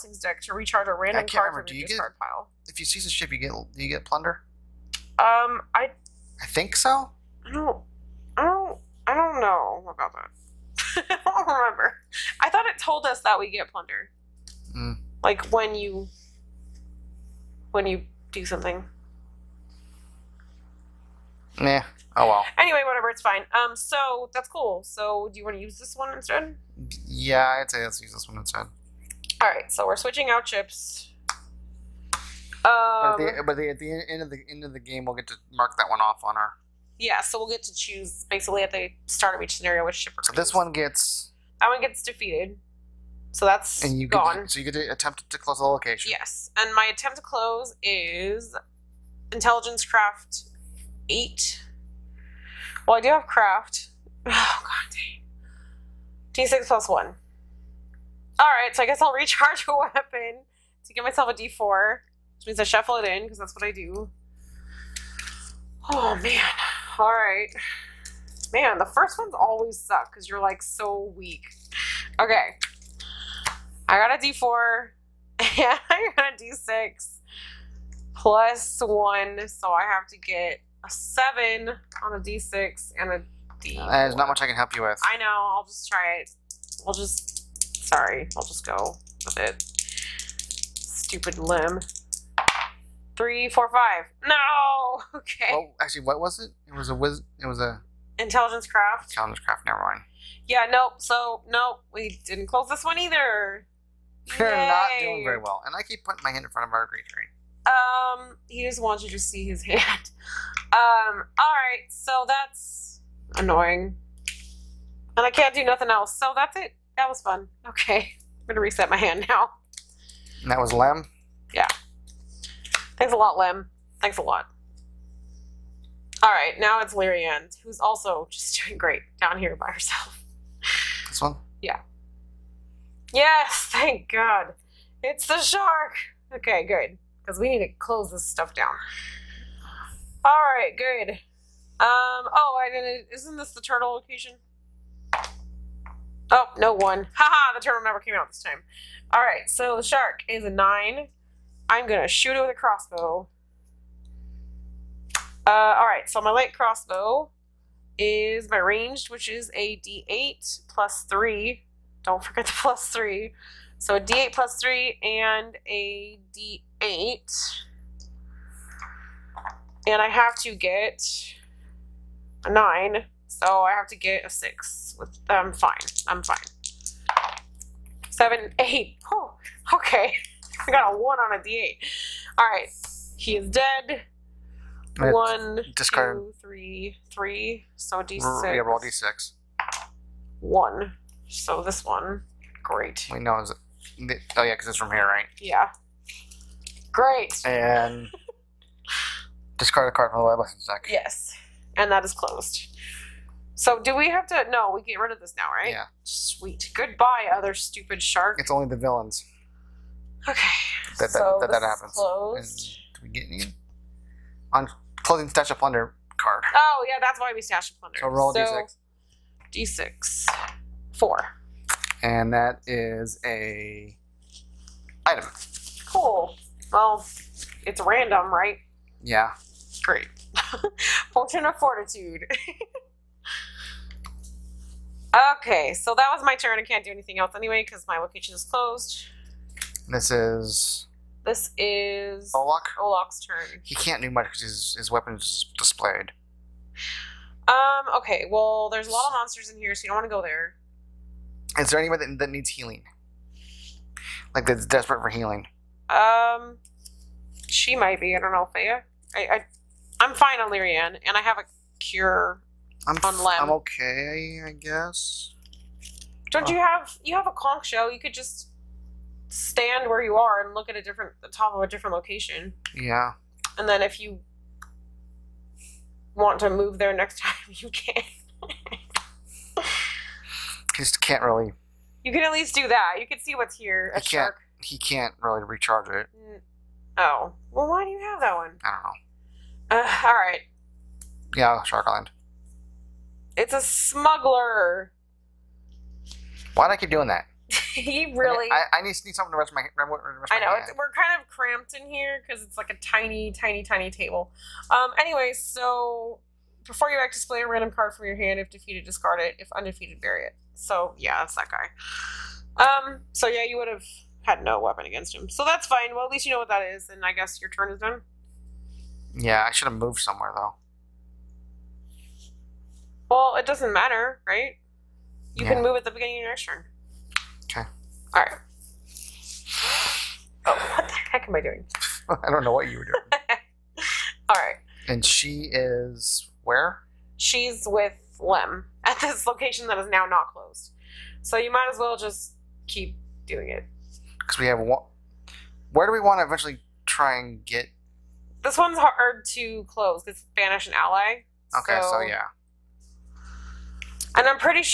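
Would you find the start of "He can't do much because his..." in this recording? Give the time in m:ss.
4:03.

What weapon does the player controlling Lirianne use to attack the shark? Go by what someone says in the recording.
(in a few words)
Light crossbow.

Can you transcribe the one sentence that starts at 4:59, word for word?
Rest my I know we're kind of cramped in here because it's like a tiny, tiny, tiny table.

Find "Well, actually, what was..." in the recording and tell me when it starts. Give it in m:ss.
1:35.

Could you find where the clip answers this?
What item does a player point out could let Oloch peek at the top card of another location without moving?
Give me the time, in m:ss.
4:27.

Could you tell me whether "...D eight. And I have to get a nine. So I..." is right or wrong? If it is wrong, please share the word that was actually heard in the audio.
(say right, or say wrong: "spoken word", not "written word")
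right.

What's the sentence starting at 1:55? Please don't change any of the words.
And I can't do nothing else.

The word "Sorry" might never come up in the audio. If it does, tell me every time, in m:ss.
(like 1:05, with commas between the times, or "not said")
1:27.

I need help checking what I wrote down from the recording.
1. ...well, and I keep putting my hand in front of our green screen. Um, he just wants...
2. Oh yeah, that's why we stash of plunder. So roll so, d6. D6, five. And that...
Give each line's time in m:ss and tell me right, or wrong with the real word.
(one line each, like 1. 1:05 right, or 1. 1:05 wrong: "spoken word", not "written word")
1. 1:45 right
2. 3:36 wrong: "four", not "five".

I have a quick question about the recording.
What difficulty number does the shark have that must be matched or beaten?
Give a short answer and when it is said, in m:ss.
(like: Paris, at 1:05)
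9, at 2:29.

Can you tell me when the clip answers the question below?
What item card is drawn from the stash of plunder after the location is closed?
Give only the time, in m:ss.
3:51.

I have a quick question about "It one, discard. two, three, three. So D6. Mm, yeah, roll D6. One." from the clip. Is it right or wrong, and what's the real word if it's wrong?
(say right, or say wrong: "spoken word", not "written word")
right.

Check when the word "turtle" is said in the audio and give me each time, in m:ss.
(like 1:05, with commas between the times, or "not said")
2:23, 2:27.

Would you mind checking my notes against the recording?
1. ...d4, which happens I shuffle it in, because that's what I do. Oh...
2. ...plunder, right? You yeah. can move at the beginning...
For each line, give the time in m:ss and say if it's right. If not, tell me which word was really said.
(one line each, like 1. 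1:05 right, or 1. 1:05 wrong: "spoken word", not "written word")
1. 1:01 wrong: "means", not "happens"
2. 5:23 wrong: "matter", not "plunder".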